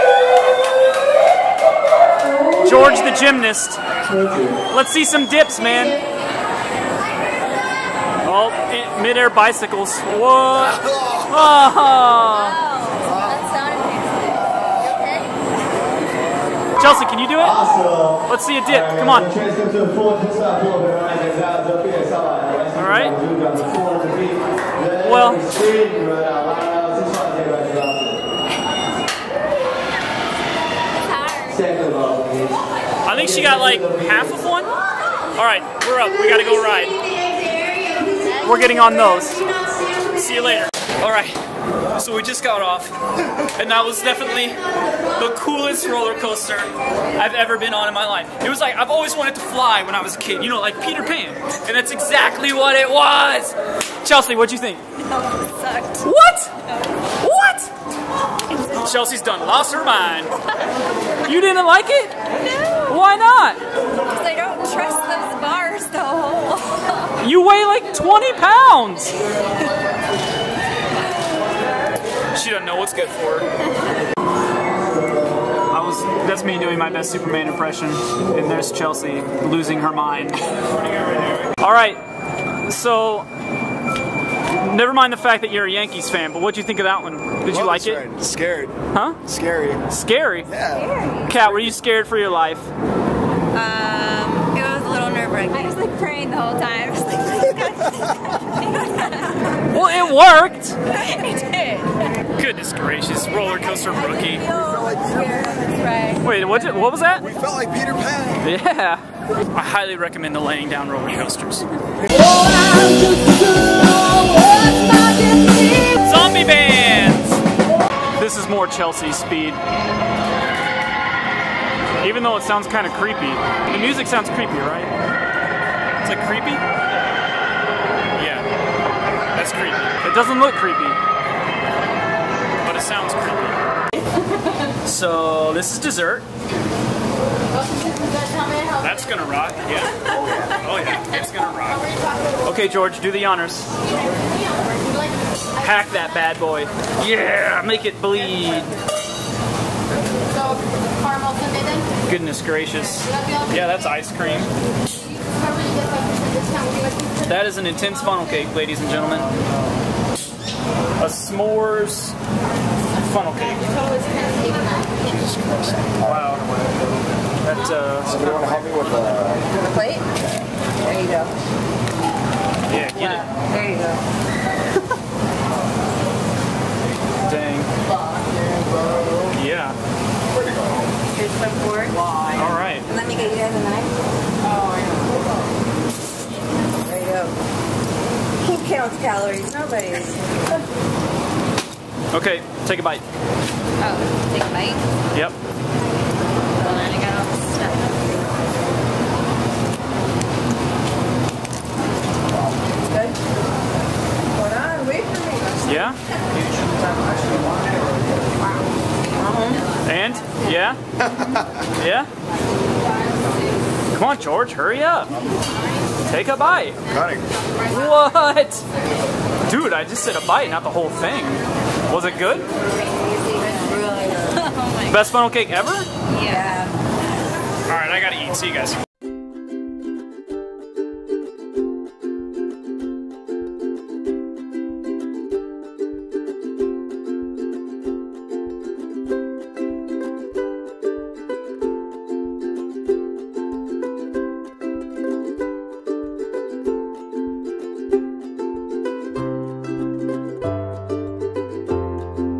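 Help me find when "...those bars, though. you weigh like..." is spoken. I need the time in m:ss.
1:05.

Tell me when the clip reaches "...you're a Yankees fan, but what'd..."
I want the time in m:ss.
1:25.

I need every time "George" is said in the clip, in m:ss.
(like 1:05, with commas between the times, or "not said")
0:02, 2:22, 3:34.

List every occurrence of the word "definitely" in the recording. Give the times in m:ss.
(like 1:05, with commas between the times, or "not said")
0:44.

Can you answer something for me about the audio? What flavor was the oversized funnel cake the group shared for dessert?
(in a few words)
S'mores.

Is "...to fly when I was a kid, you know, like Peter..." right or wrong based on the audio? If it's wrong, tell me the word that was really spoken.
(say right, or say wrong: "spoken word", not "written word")
right.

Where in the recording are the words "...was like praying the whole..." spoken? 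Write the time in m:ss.
1:35.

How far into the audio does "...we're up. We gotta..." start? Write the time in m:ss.
0:35.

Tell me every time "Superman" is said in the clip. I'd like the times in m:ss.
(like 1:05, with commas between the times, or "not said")
1:17.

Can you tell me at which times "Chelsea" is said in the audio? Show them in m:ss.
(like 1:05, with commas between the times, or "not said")
0:16, 0:54, 0:58, 1:18, 1:58.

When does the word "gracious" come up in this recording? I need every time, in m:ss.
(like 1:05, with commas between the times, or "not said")
1:42, 2:32.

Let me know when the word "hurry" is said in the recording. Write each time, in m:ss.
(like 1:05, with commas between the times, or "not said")
3:34.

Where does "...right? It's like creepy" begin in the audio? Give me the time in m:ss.
2:04.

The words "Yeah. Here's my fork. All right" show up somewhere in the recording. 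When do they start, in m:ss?
2:59.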